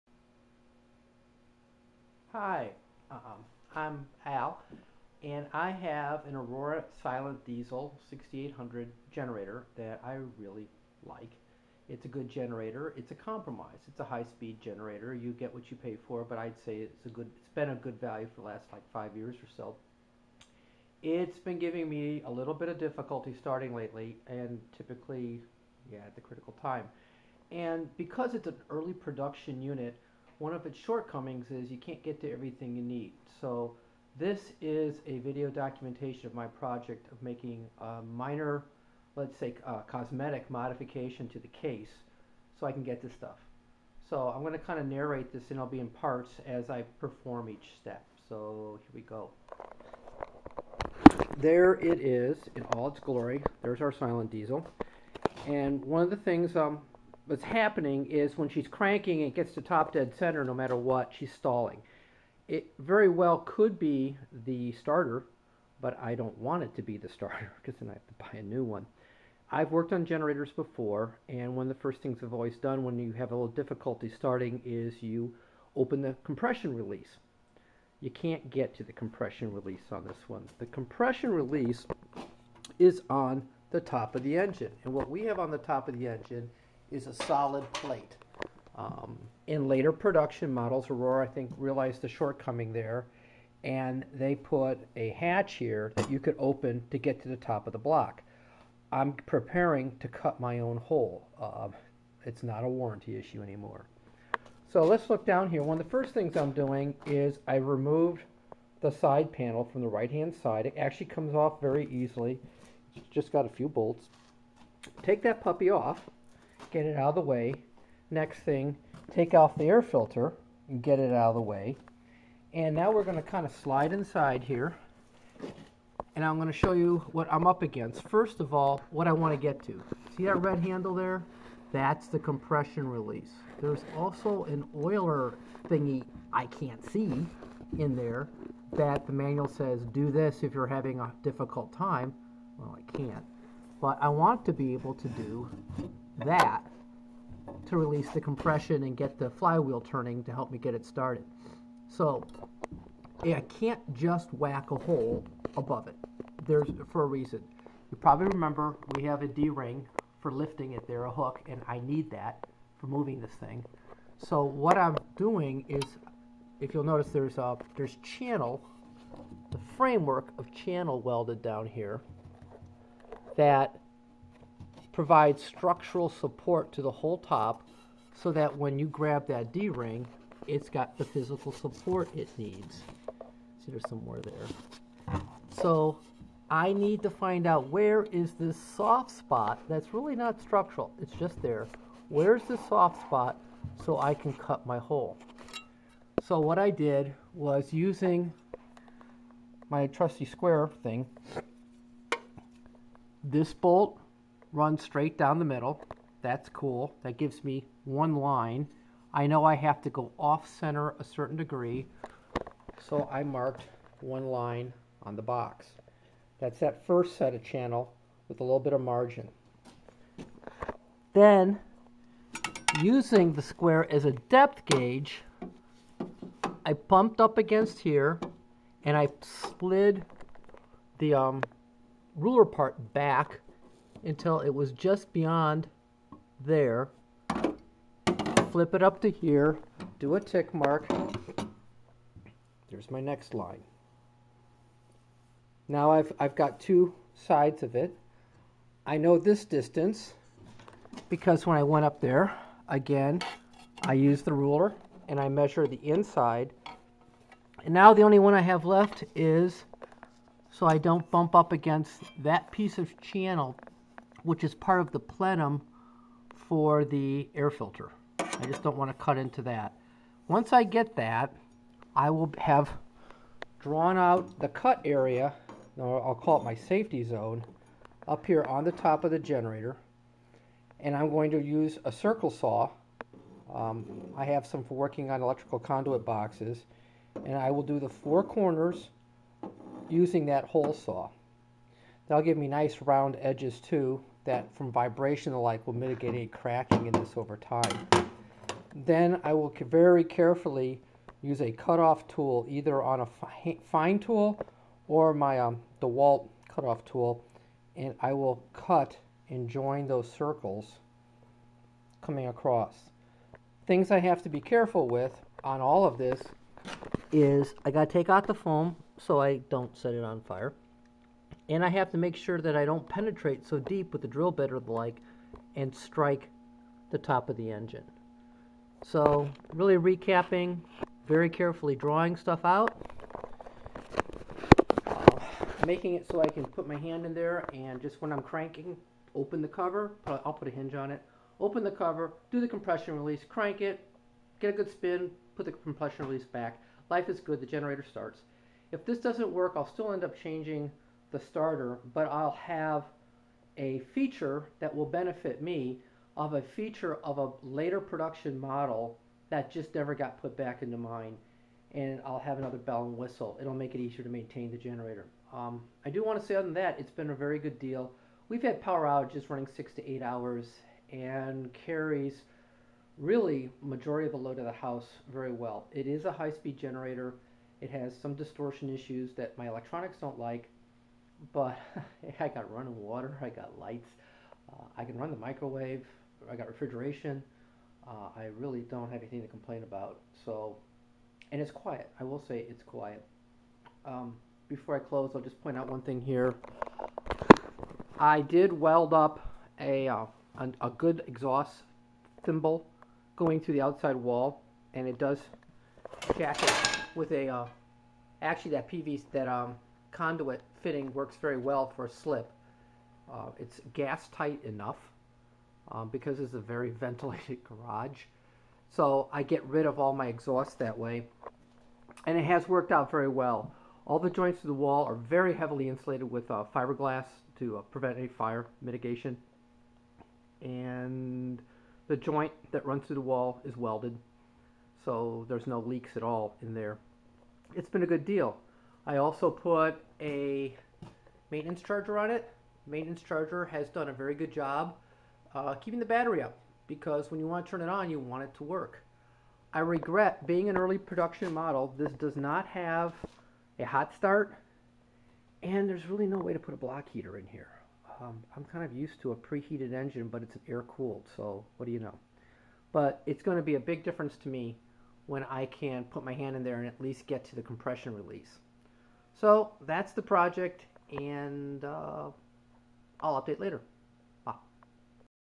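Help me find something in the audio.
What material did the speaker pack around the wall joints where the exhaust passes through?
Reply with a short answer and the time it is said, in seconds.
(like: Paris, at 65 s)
Fiberglass, at 426 s.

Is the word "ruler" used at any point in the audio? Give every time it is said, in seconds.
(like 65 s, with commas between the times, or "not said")
232 s, 254 s.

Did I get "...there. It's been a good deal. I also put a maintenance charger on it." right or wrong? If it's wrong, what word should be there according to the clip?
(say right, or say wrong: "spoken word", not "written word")
right.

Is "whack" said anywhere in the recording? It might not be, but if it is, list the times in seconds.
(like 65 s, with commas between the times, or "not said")
154 s.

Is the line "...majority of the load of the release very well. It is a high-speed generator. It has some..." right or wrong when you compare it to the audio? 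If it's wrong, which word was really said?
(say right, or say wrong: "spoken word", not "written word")
wrong: "house", not "release".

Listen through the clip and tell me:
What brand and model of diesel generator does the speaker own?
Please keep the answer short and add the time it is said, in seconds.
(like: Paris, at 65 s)
Aurora Silent Diesel 6800, at 6 s.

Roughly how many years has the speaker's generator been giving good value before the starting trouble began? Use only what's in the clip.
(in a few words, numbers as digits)
5.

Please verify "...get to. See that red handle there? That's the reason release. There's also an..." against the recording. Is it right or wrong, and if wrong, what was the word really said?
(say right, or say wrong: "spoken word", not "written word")
wrong: "compression", not "reason".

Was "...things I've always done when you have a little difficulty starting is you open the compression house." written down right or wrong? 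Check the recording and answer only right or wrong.
wrong.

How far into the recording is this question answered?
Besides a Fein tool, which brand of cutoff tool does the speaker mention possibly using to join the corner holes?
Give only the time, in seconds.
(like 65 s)
305 s.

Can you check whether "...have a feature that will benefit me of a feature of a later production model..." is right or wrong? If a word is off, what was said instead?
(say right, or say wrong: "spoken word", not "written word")
right.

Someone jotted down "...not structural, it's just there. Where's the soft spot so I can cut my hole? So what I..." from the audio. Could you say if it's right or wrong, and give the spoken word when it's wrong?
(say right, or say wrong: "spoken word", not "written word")
right.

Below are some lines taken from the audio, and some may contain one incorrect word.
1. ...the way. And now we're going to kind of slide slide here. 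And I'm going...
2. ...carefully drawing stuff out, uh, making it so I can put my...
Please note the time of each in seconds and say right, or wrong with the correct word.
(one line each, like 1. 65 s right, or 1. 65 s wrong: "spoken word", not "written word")
1. 121 s wrong: "inside", not "slide"
2. 331 s right.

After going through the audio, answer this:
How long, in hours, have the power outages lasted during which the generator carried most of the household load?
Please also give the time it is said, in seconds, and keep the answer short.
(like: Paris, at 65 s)
6 to 8 hours, at 369 s.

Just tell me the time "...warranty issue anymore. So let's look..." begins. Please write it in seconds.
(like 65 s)
102 s.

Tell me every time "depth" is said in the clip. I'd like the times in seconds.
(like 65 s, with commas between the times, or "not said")
224 s.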